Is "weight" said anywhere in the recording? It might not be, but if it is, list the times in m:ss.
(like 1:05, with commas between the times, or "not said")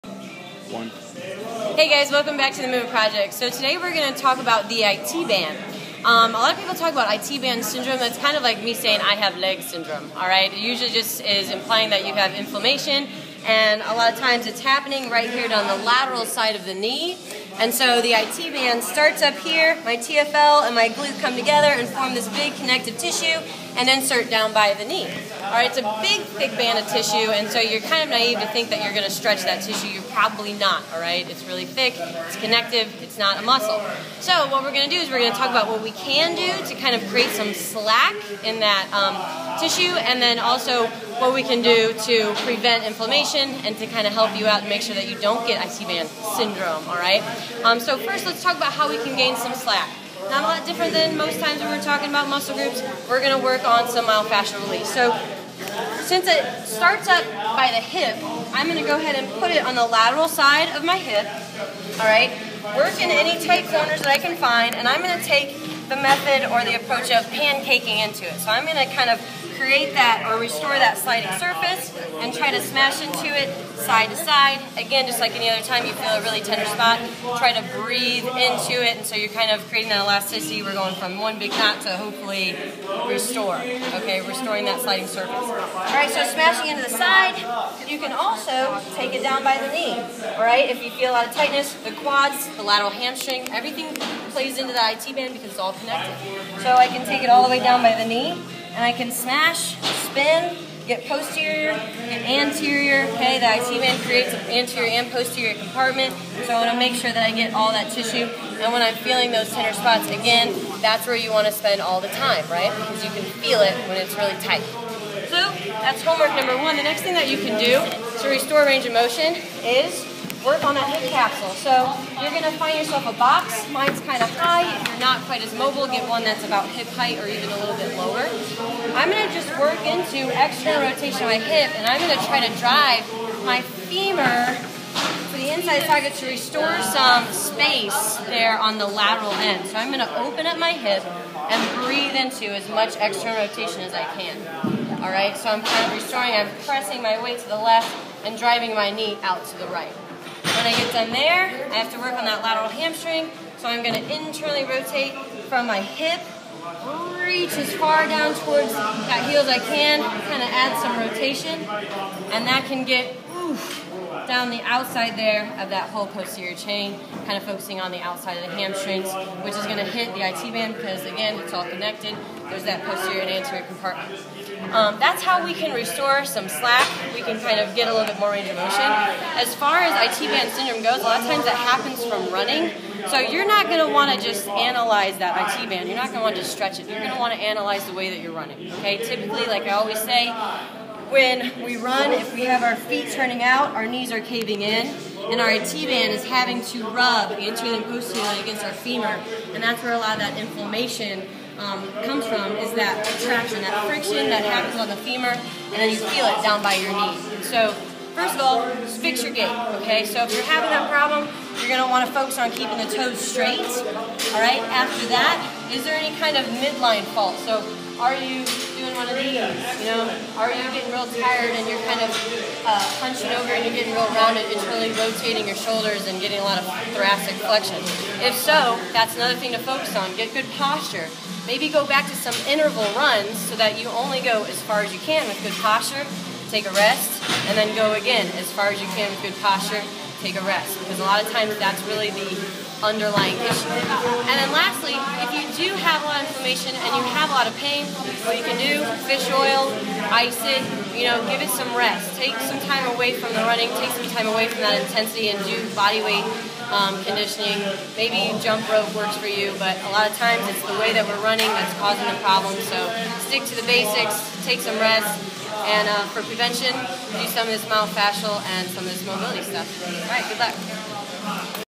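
2:27, 4:16.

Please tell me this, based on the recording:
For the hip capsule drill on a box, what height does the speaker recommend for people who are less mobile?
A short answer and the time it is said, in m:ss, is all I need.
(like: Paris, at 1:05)
about hip height, at 2:06.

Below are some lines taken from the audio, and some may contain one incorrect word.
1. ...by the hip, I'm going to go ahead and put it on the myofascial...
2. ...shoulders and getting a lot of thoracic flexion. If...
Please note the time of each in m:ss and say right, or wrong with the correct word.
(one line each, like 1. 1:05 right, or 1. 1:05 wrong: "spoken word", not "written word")
1. 0:57 wrong: "lateral", not "myofascial"
2. 3:45 right.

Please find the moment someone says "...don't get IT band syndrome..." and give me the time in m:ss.
0:45.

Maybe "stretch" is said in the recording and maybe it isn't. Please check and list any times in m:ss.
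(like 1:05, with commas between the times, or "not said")
0:29, 3:06.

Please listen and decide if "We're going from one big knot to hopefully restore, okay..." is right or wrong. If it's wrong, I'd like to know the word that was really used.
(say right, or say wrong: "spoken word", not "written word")
right.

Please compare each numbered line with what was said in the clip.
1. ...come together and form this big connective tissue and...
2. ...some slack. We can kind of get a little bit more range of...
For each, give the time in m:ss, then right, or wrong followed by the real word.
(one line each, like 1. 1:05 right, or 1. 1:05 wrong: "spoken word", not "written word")
1. 0:21 right
2. 2:56 right.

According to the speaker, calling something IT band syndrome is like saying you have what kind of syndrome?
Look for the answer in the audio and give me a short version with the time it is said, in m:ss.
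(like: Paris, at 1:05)
leg syndrome, at 0:09.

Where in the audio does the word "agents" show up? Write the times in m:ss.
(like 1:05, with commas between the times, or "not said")
not said.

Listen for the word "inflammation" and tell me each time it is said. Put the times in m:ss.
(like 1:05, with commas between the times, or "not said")
0:12, 0:42, 3:20, 4:06.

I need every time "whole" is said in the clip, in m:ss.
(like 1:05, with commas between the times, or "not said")
2:45.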